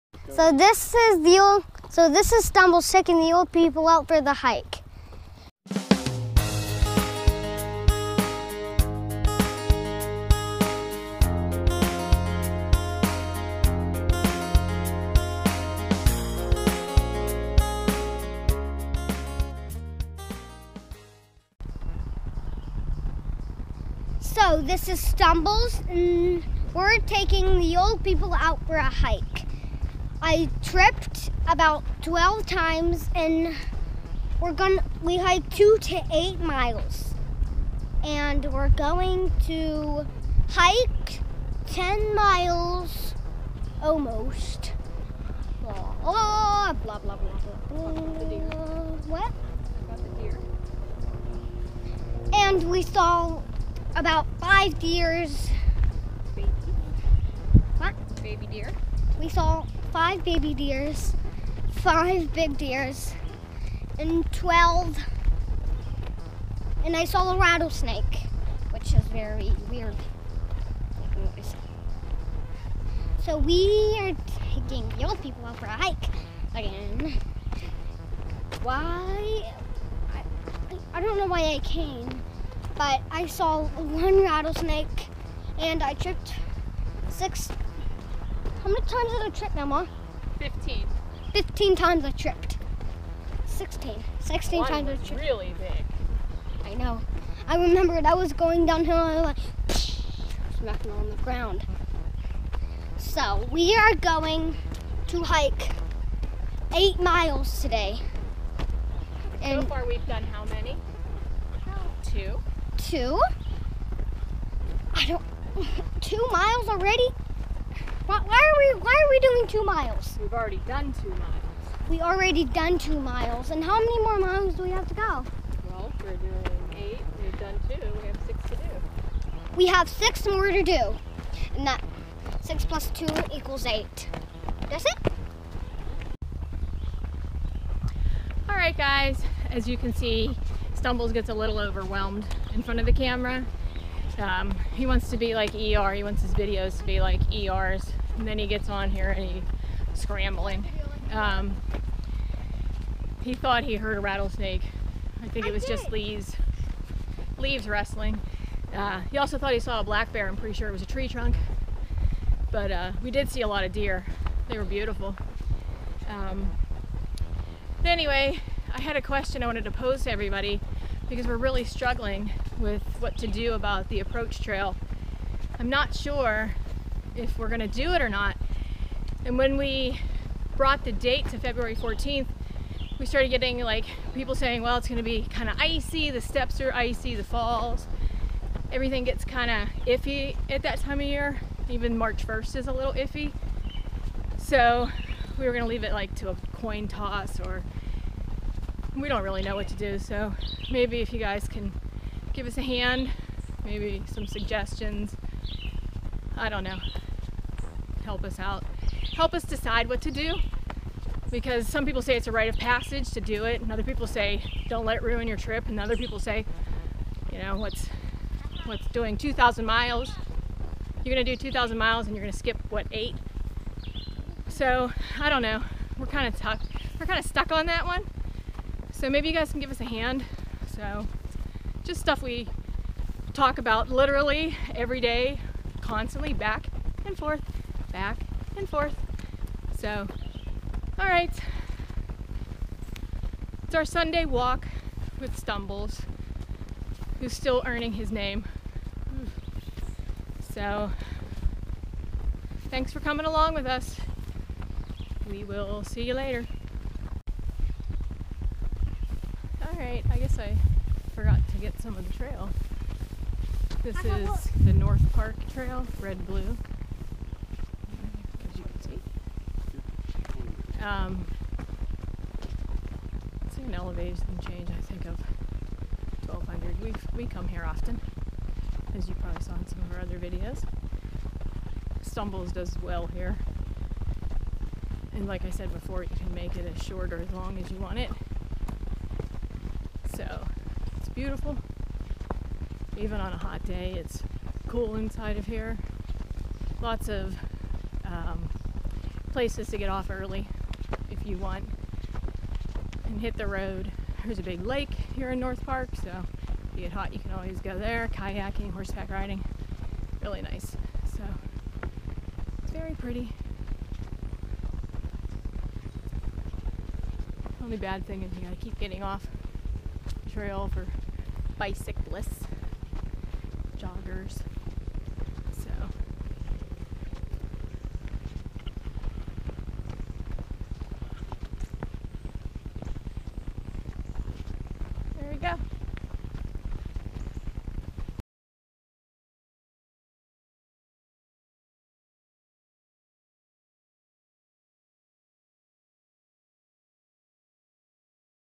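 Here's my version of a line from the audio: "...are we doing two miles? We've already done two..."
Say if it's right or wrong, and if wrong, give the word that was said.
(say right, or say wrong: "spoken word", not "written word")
right.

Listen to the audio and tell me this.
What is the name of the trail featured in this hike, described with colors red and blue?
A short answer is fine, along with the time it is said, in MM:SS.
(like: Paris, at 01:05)
North Park Trail, at 04:24.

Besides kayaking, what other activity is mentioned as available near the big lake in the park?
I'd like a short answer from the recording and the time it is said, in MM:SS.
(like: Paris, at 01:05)
horseback riding, at 05:08.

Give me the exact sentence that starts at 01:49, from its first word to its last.
And so far we've done how many?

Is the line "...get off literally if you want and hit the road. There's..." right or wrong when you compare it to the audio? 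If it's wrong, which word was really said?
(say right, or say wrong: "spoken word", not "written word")
wrong: "early", not "literally".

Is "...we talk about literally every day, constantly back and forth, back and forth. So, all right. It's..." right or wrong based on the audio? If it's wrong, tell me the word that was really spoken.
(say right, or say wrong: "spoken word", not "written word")
right.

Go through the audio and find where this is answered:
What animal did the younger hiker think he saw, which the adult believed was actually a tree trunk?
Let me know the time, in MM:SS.
02:39.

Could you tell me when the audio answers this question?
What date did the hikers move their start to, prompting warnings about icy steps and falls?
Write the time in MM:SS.
03:01.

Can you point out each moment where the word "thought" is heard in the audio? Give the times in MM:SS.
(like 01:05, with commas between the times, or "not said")
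02:33, 02:39.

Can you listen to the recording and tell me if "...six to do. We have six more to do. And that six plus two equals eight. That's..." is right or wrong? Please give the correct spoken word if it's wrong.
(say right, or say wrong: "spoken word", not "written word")
right.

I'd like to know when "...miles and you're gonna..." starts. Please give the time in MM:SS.
03:41.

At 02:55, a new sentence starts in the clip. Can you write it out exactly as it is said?
I'm not sure if we're gonna do it or not.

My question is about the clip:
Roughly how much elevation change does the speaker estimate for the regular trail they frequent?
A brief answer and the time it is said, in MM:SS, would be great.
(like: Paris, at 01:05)
1200, at 04:36.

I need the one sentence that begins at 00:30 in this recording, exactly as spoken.
I tripped about 12 times and we're going to we hiked 2 to 8 miles.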